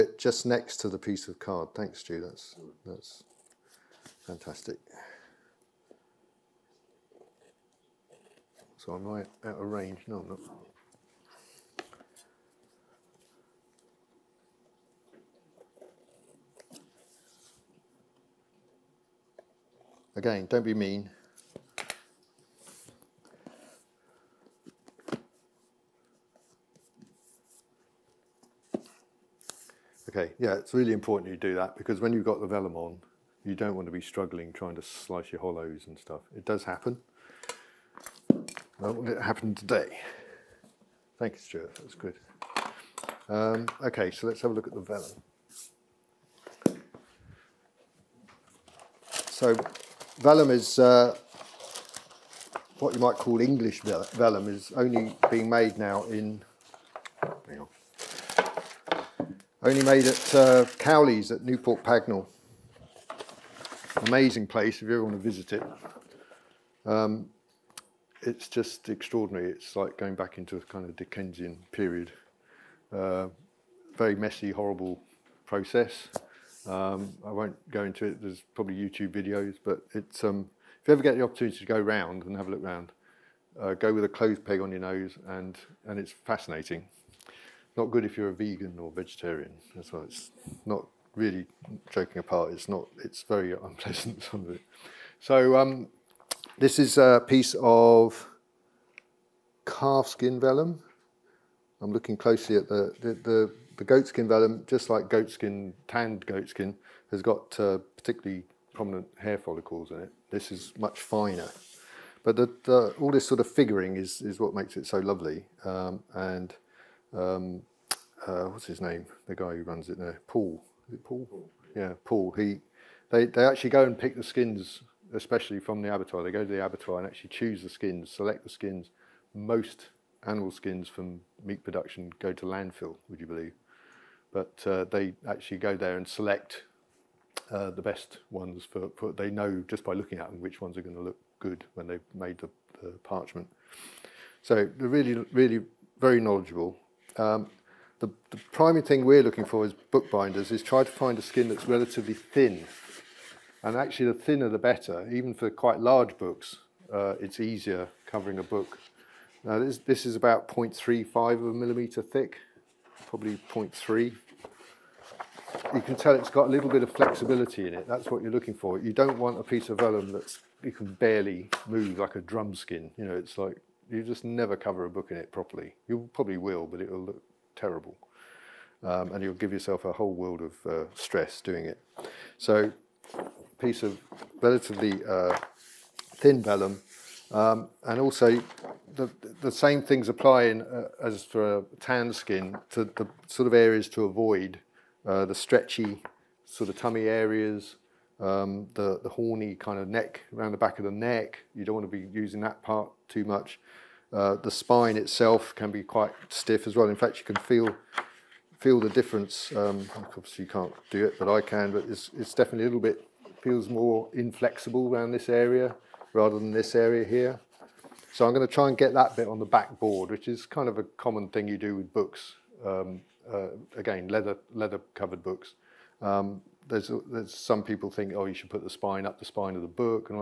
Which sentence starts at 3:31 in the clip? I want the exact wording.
But it's, it's definitely a little bit feels more inflexible around this area rather than this area here.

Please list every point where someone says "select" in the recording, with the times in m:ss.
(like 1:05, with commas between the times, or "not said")
2:08, 2:16.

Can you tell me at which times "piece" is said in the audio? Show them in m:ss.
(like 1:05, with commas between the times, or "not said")
0:00, 1:37, 2:49, 3:03.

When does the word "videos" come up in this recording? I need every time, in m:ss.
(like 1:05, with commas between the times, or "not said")
1:19.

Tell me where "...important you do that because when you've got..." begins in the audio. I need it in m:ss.
0:30.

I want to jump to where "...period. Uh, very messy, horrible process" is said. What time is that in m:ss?
1:11.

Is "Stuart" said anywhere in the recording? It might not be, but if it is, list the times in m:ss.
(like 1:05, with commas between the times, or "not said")
0:41.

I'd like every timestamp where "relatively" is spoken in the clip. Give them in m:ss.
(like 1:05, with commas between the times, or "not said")
2:31, 3:04.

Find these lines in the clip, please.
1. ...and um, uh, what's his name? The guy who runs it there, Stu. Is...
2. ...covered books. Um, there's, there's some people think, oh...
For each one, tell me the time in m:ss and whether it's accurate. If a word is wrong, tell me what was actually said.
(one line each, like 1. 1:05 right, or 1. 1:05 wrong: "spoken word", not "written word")
1. 1:56 wrong: "Paul", not "Stu"
2. 3:44 right.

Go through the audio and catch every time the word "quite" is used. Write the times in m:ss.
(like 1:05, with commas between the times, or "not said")
2:35, 3:25.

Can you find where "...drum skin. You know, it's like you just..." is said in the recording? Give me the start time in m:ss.
2:52.